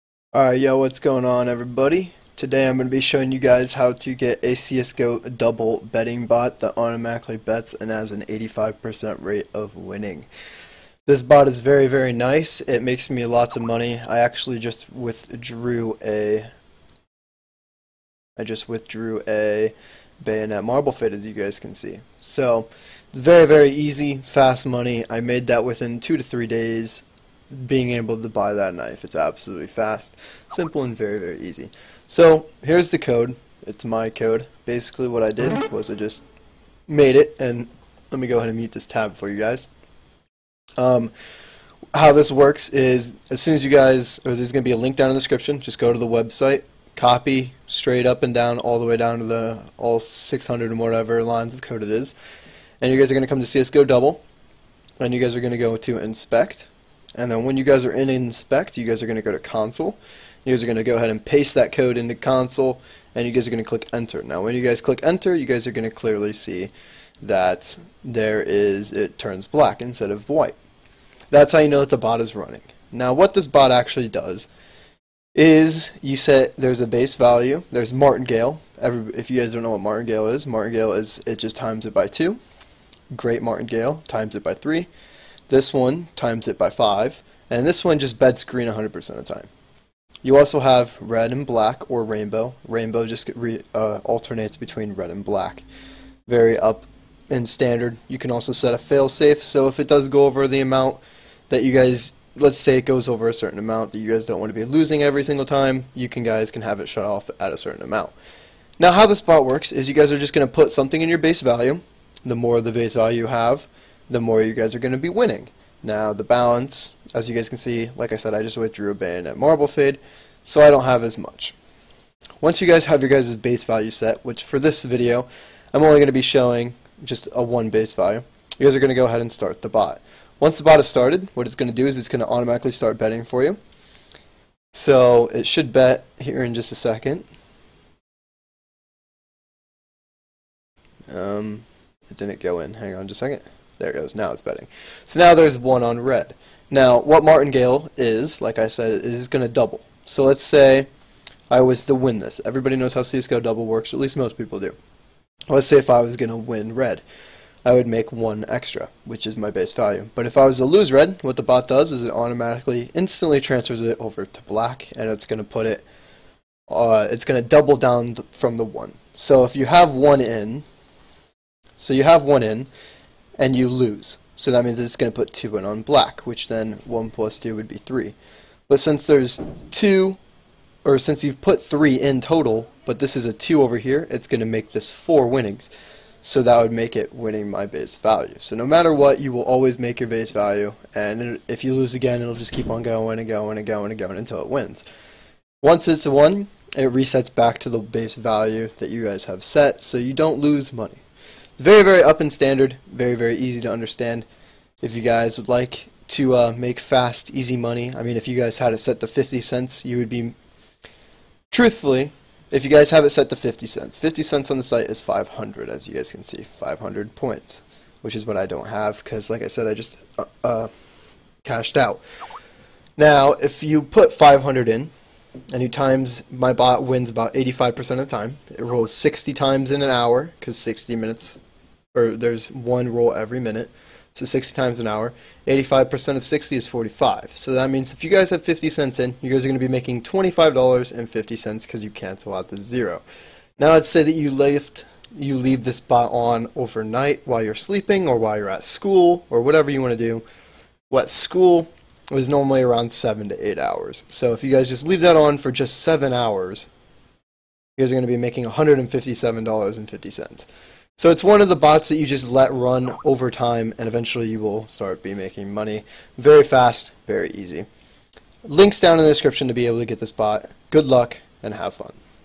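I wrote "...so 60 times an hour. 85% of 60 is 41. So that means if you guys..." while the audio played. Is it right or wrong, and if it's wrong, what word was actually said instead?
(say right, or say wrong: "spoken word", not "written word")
wrong: "45", not "41".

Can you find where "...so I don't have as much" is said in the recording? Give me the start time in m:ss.
2:00.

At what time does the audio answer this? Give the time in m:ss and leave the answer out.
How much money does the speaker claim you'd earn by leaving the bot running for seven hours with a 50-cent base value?
4:18.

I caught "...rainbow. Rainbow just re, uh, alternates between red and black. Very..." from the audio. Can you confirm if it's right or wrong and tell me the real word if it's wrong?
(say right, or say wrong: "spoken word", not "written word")
right.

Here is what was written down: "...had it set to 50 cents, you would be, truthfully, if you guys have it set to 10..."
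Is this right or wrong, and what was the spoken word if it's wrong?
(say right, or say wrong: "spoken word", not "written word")
wrong: "50", not "10".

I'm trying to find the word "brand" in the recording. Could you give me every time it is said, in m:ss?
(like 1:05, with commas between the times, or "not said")
not said.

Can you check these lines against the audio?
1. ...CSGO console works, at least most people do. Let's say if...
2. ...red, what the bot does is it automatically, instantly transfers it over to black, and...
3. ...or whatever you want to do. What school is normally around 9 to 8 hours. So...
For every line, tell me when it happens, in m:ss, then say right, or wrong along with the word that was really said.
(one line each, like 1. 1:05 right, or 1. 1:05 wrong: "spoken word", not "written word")
1. 2:33 wrong: "double", not "console"
2. 2:40 right
3. 4:09 wrong: "7", not "9".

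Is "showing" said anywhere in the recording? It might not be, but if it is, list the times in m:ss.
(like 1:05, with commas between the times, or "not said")
0:03, 2:06.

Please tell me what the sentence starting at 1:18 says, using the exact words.
Every, if you guys don't know what martingale is, martingale is it just times it by 2.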